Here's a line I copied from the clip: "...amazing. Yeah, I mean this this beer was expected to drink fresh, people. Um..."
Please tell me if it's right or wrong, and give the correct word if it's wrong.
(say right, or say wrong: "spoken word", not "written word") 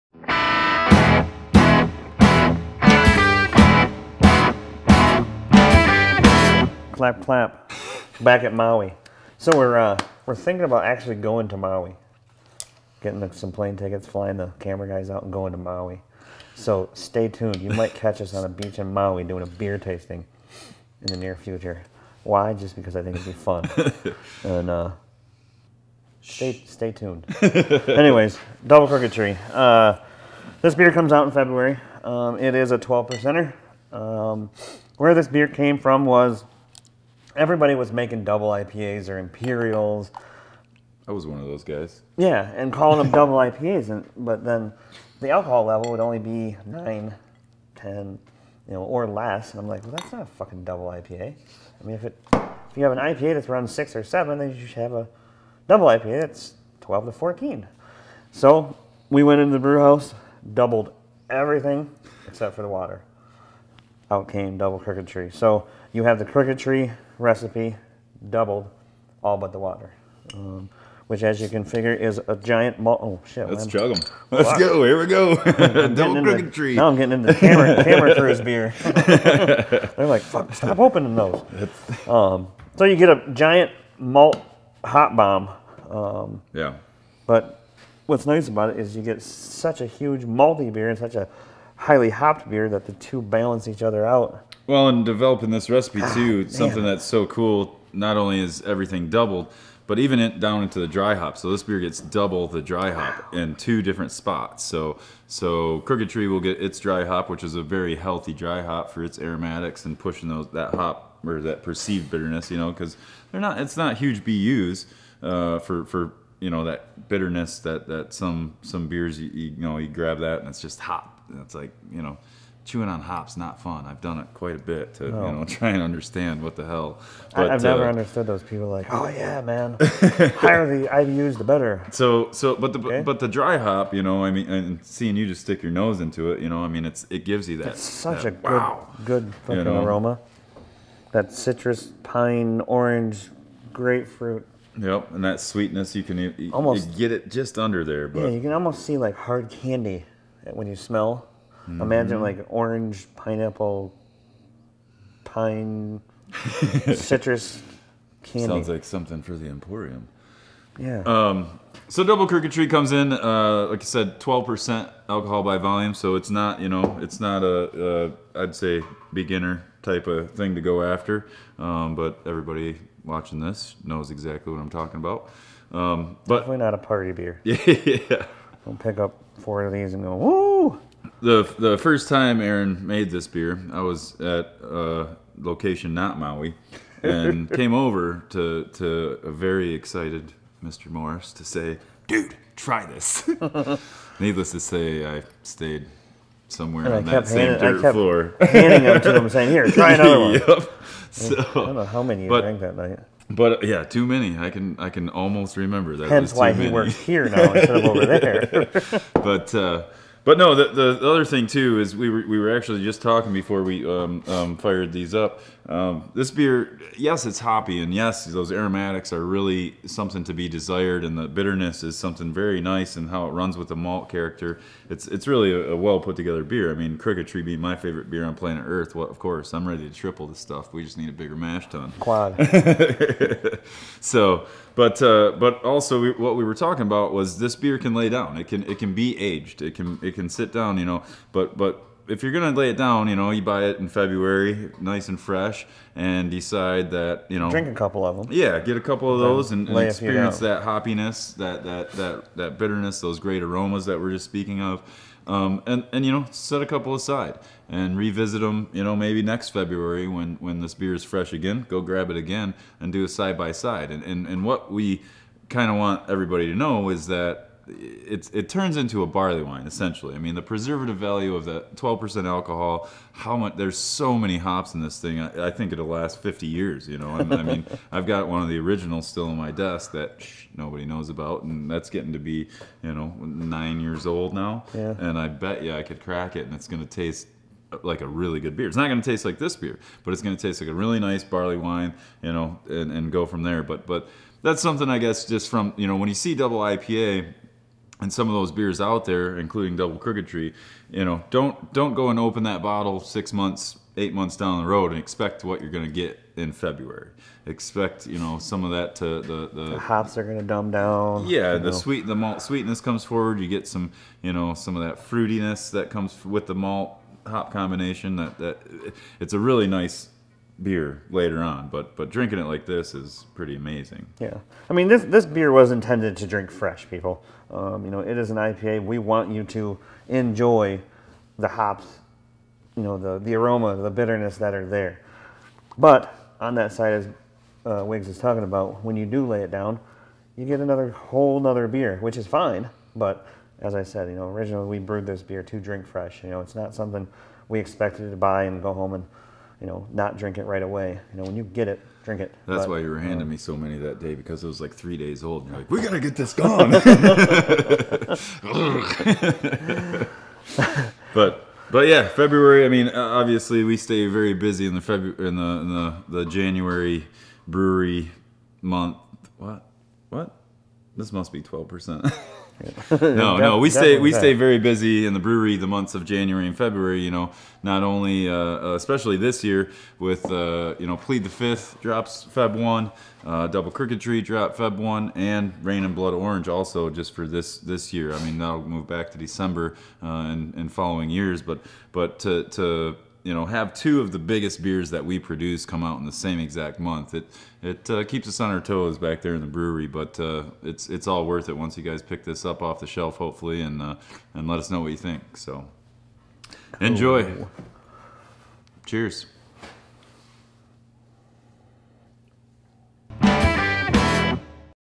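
wrong: "intended", not "expected".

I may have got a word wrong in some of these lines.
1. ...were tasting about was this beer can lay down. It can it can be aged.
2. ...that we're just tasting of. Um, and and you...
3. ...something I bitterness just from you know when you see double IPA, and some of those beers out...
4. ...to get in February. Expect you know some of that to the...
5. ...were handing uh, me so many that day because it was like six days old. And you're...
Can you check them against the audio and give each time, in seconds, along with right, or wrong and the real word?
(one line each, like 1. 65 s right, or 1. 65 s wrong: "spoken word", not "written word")
1. 236 s wrong: "talking", not "tasting"
2. 253 s wrong: "speaking", not "tasting"
3. 294 s wrong: "guess", not "bitterness"
4. 305 s right
5. 352 s wrong: "three", not "six".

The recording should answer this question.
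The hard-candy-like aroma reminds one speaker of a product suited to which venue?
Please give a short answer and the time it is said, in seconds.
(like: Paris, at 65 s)
the Emporium, at 159 s.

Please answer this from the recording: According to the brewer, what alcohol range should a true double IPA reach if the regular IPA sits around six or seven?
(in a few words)
12 to 14.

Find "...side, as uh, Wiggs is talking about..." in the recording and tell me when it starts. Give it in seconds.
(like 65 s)
336 s.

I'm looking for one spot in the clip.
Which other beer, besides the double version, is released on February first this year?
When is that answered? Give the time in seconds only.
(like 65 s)
380 s.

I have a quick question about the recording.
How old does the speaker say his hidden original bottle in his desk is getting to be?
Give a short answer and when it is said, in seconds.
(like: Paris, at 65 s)
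9 years, at 283 s.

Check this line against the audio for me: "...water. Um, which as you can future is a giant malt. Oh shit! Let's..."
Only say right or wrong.
wrong.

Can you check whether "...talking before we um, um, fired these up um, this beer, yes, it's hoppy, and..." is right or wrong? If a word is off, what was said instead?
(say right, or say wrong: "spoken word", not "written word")
right.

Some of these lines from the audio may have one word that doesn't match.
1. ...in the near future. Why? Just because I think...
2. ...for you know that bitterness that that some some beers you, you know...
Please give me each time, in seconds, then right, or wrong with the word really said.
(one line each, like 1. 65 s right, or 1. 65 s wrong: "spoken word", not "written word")
1. 21 s right
2. 115 s right.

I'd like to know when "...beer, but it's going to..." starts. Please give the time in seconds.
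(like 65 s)
289 s.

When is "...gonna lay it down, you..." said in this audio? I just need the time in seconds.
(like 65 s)
242 s.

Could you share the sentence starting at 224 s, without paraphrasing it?
It's it's really a, a, well put together beer.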